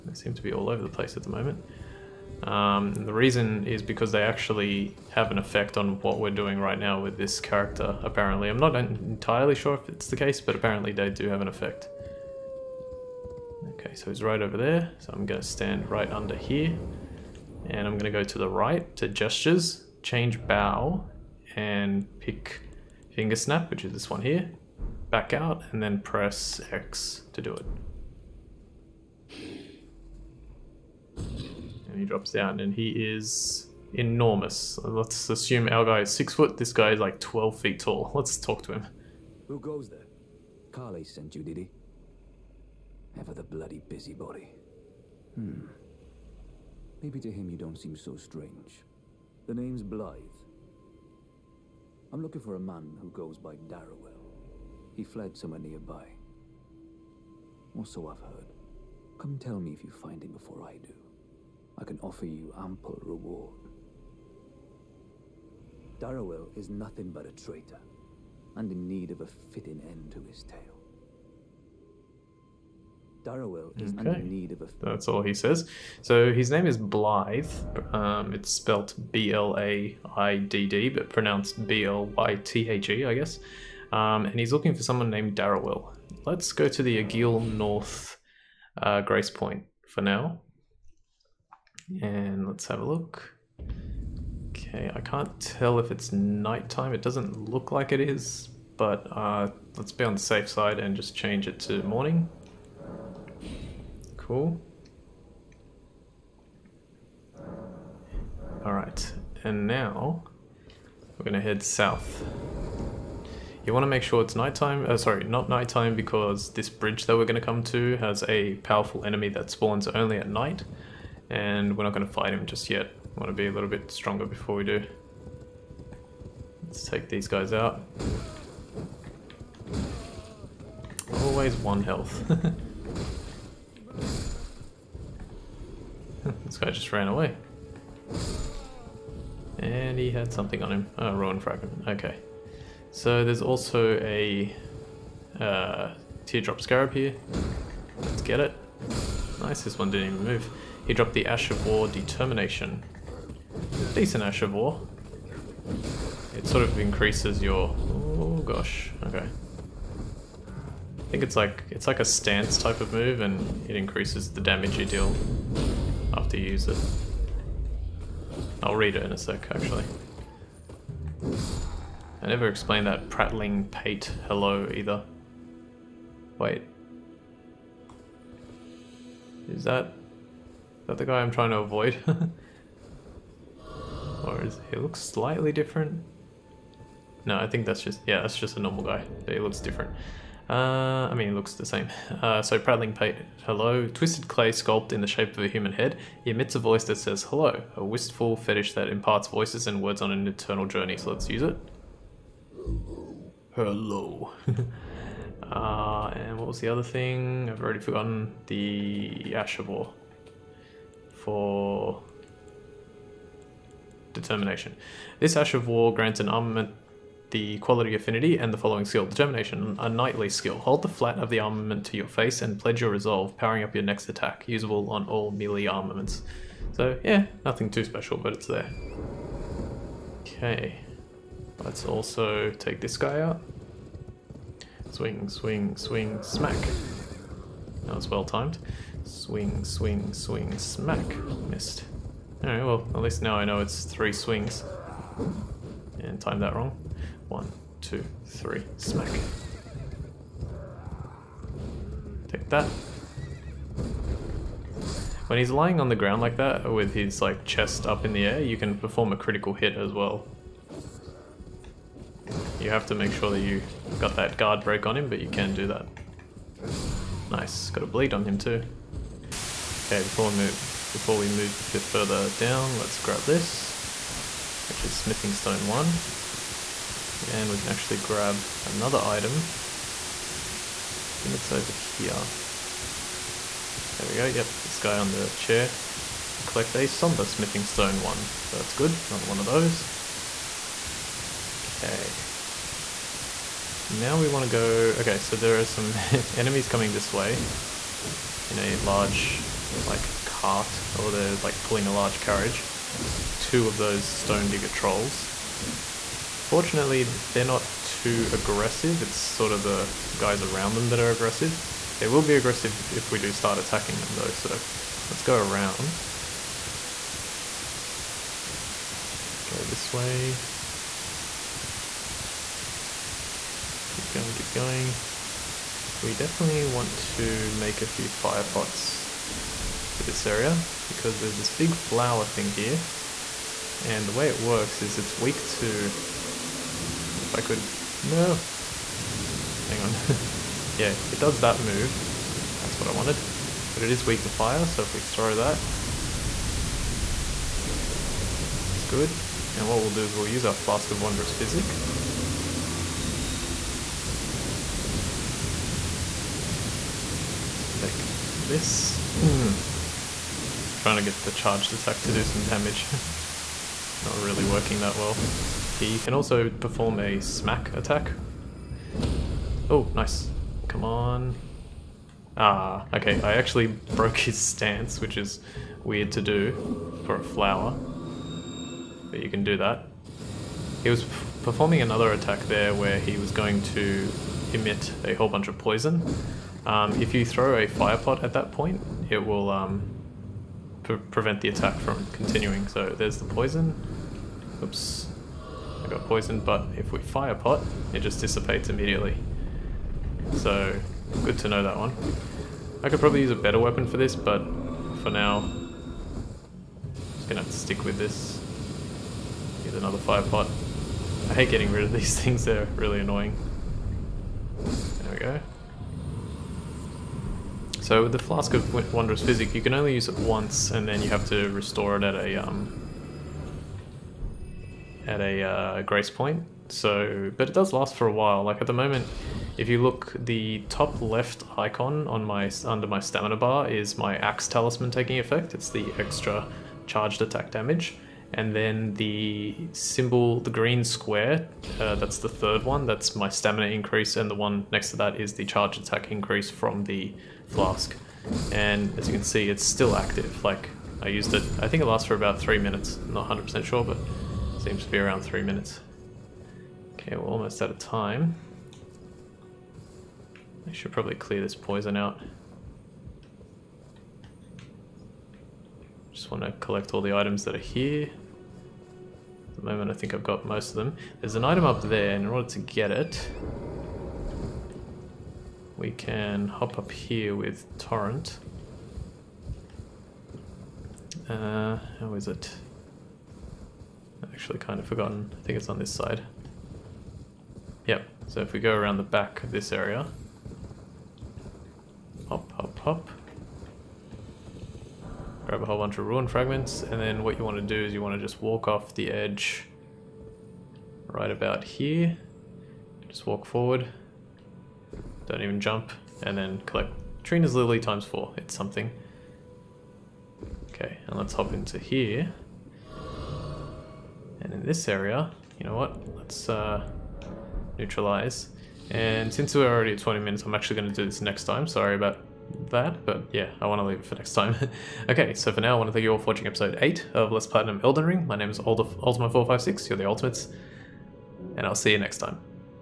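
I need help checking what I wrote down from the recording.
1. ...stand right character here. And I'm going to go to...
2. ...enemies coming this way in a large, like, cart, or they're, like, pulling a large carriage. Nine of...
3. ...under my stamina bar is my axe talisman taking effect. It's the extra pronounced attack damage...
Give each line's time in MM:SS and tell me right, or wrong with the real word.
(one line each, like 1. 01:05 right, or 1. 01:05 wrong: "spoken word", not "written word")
1. 00:15 wrong: "under", not "character"
2. 04:56 wrong: "Two", not "Nine"
3. 07:12 wrong: "charged", not "pronounced".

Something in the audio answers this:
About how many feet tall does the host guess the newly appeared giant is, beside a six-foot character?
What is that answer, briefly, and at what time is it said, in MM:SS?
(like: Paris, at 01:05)
12, at 00:37.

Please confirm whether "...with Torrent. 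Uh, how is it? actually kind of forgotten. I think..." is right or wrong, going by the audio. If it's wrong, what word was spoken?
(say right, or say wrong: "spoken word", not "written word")
right.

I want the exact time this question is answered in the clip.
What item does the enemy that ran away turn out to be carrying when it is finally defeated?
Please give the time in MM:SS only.
02:21.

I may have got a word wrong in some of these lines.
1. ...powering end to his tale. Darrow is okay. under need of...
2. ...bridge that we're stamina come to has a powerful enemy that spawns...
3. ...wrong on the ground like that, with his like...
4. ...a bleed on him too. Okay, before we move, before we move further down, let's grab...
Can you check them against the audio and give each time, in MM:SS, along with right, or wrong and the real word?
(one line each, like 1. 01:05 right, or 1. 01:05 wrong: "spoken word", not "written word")
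1. 01:09 wrong: "fitting", not "powering"
2. 01:56 wrong: "gonna", not "stamina"
3. 04:15 wrong: "lying", not "wrong"
4. 04:27 right.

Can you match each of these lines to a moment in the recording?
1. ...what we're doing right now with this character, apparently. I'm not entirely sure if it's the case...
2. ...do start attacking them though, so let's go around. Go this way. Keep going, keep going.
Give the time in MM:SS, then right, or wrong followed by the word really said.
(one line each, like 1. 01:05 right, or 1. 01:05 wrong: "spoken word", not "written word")
1. 00:06 right
2. 05:13 right.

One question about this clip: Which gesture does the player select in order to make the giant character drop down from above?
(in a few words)
Finger snap.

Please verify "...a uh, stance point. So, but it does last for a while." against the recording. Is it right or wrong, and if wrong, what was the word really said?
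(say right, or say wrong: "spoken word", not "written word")
wrong: "grace", not "stance".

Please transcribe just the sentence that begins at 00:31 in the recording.
And he drops down, and he is enormous.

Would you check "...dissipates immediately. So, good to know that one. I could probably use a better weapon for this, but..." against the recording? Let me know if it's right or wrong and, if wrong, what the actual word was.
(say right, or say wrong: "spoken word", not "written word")
right.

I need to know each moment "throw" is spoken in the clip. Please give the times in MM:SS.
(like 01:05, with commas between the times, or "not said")
05:44, 06:27.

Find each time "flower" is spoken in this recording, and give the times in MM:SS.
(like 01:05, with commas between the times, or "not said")
05:31, 06:17.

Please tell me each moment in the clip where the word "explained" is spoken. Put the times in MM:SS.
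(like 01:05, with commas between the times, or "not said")
02:52.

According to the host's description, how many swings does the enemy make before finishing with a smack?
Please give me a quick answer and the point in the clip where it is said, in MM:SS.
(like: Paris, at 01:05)
3, at 04:03.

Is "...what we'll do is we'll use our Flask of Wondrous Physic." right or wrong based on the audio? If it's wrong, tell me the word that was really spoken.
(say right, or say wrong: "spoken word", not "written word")
right.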